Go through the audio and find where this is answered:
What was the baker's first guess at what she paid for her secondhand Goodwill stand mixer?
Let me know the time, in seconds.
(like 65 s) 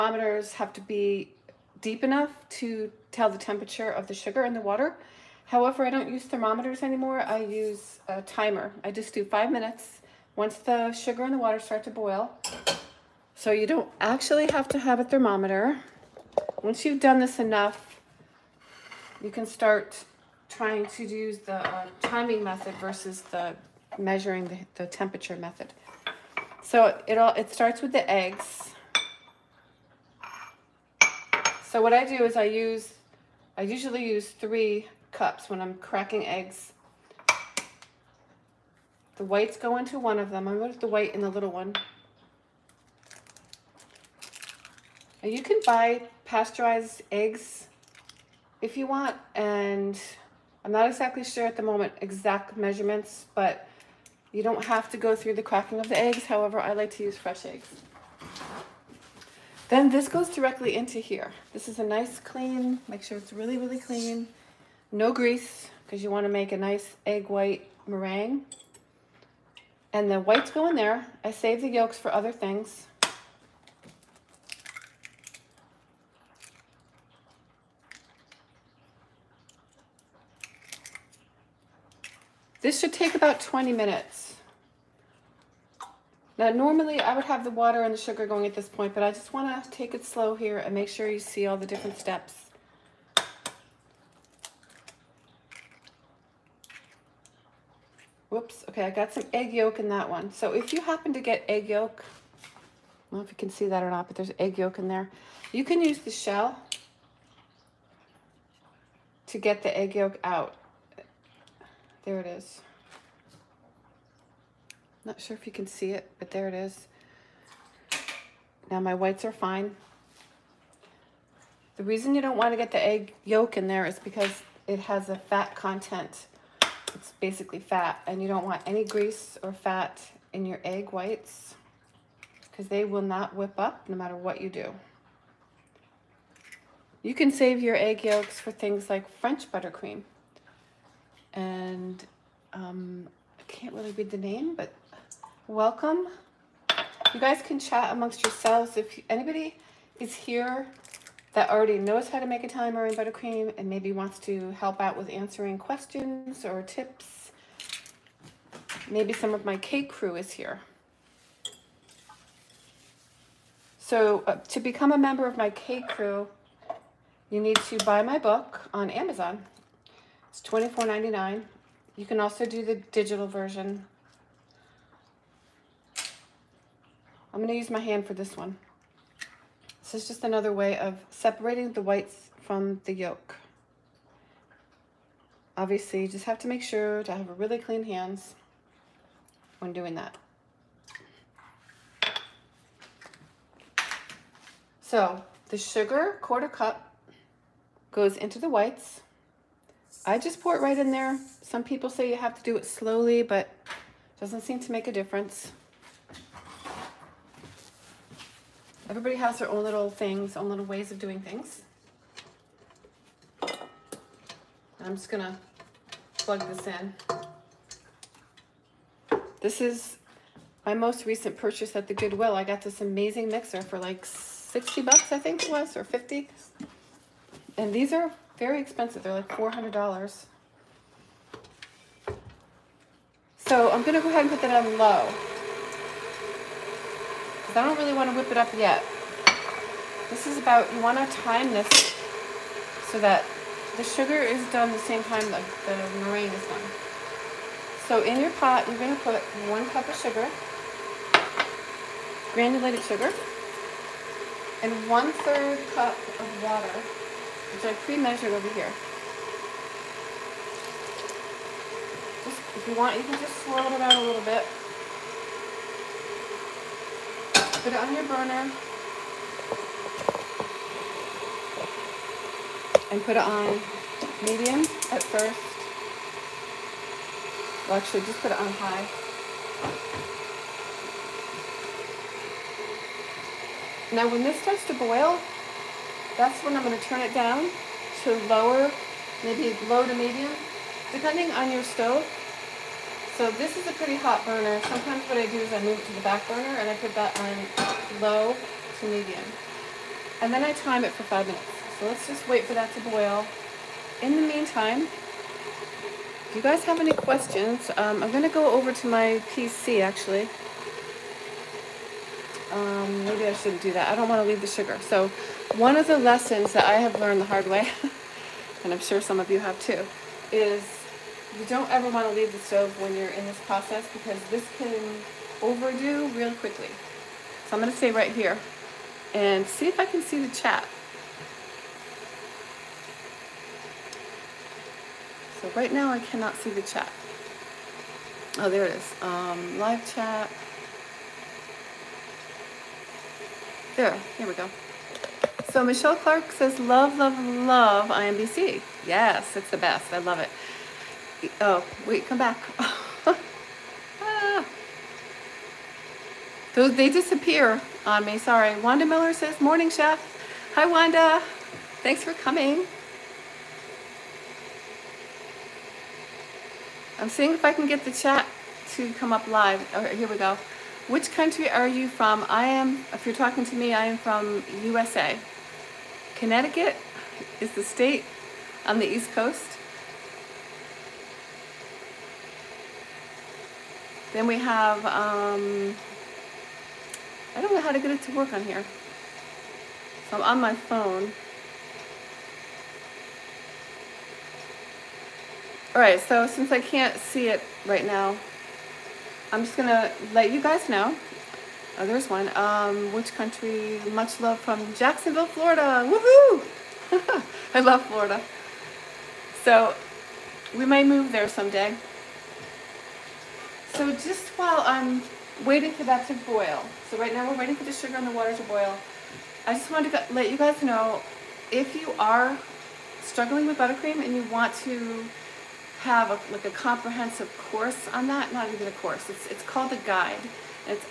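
224 s.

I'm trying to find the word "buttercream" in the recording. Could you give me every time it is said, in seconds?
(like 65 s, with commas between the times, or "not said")
139 s, 152 s, 423 s.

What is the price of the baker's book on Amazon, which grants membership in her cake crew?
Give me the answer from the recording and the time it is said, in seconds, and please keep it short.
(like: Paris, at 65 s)
$24.99, at 170 s.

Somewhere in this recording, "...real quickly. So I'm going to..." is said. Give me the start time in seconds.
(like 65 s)
326 s.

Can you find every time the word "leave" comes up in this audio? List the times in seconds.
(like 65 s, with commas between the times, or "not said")
314 s, 322 s.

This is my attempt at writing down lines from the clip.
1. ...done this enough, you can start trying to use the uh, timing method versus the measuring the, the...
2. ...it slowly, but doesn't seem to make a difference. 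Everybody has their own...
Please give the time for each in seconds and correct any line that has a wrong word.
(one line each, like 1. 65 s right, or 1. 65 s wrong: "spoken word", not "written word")
1. 16 s right
2. 202 s right.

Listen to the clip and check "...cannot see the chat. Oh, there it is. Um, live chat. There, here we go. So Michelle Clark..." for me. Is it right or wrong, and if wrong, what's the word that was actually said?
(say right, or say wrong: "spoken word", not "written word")
right.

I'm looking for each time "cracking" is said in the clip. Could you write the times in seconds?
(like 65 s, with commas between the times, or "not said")
35 s, 55 s.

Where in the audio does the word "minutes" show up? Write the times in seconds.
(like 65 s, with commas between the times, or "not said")
9 s, 83 s, 301 s.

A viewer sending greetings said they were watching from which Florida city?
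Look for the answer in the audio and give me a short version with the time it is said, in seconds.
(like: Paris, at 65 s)
Jacksonville, at 404 s.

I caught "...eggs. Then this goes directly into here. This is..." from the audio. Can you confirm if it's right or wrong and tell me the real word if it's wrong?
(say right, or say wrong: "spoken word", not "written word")
right.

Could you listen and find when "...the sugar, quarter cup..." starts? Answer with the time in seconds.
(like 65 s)
195 s.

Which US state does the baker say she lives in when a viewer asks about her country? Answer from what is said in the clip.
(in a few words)
Connecticut.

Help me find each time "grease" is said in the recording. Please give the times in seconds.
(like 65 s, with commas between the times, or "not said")
65 s, 128 s.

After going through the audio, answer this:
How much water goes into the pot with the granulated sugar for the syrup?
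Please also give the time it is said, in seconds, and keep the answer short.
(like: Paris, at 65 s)
1/3 cup, at 254 s.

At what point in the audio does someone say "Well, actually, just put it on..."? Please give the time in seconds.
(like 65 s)
277 s.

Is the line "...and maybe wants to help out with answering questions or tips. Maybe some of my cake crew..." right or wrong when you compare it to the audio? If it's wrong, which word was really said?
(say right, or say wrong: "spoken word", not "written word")
right.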